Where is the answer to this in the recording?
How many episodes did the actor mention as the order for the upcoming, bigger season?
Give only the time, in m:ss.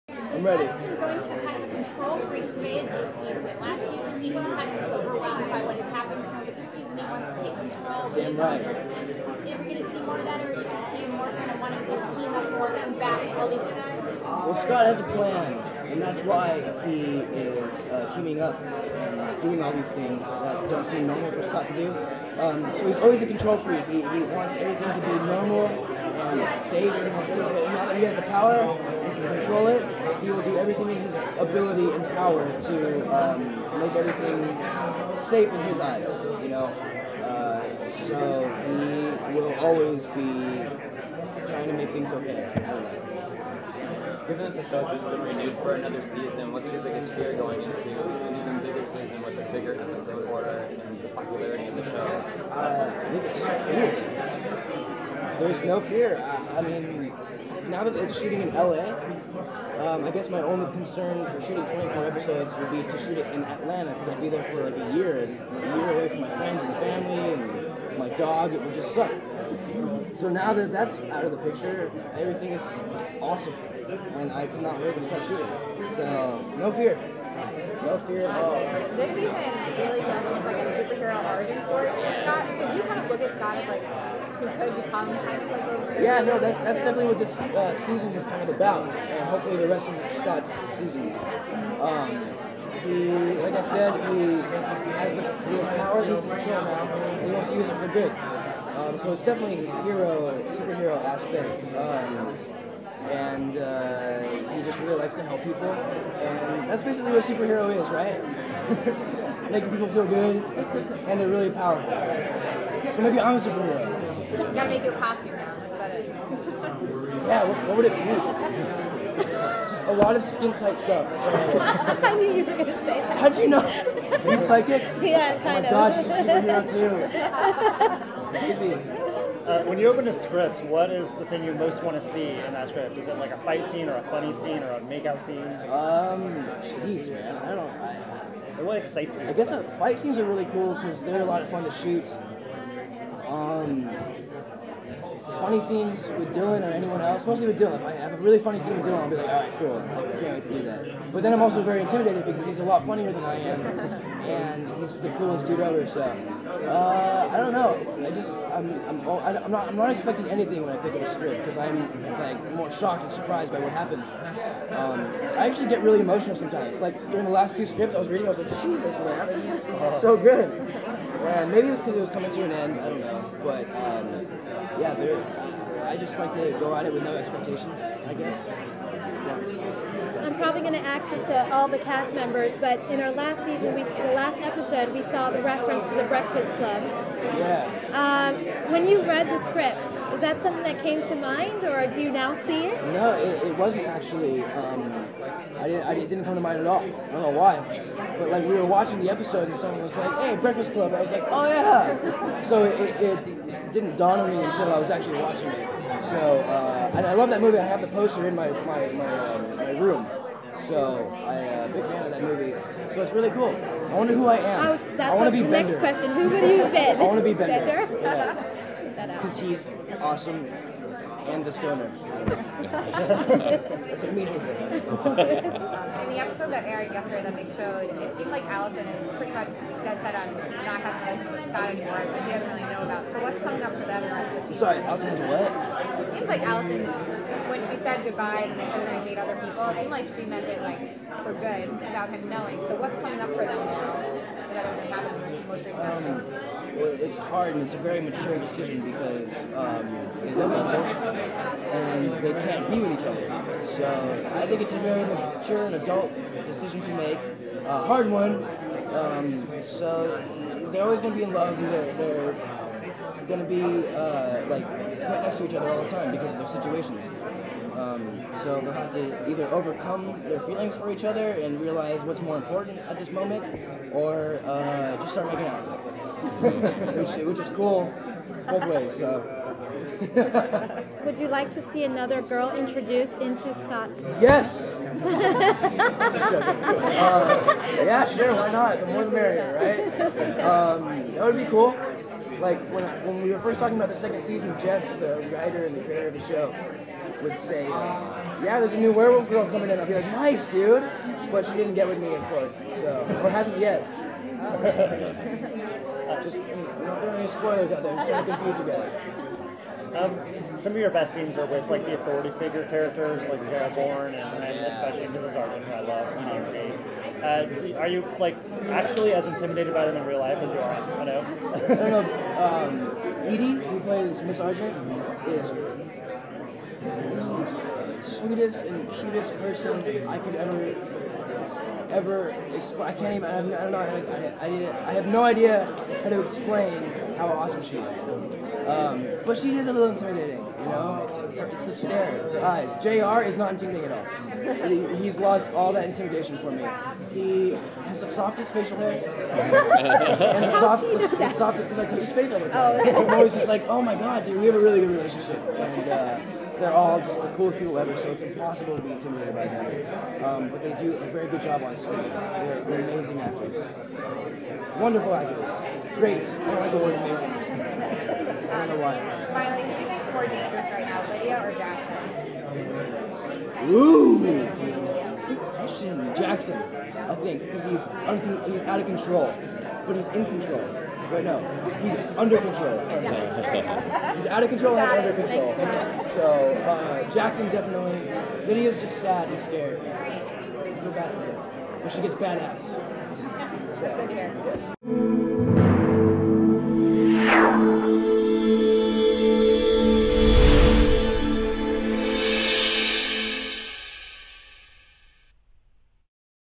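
1:01.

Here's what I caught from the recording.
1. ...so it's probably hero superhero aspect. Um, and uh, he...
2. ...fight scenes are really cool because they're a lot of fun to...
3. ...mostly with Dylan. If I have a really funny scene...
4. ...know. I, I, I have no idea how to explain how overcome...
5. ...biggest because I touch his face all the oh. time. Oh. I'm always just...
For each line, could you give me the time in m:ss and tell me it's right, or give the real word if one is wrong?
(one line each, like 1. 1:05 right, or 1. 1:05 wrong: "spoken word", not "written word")
1. 1:38 wrong: "definitely", not "probably"
2. 2:19 right
3. 2:27 right
4. 5:33 wrong: "awesome", not "overcome"
5. 5:51 wrong: "softest", not "biggest".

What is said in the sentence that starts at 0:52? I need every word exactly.
Uh, I think it's fear there's no fear.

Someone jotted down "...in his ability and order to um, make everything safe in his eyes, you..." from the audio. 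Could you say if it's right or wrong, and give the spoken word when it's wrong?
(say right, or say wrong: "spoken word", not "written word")
wrong: "power", not "order".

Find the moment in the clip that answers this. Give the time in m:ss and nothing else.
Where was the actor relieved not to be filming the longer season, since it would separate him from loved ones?
1:03.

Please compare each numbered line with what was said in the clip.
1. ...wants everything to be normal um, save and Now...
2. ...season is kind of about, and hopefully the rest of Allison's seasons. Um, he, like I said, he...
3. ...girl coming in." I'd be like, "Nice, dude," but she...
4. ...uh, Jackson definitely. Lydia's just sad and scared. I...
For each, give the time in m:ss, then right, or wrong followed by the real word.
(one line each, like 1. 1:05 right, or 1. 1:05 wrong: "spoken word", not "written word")
1. 0:24 right
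2. 1:27 wrong: "Scott", not "Allison"
3. 4:59 right
4. 6:26 right.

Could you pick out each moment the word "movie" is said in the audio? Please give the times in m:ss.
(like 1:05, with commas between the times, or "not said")
3:27, 3:32.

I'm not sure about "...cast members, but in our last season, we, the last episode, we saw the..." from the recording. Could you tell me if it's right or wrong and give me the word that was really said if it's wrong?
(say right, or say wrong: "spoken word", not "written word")
right.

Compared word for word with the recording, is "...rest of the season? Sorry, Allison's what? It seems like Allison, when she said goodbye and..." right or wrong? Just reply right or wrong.
right.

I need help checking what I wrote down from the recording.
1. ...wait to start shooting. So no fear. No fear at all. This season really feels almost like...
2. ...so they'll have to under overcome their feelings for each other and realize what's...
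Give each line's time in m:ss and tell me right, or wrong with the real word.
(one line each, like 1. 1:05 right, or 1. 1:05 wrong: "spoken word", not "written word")
1. 1:14 right
2. 4:28 wrong: "either", not "under".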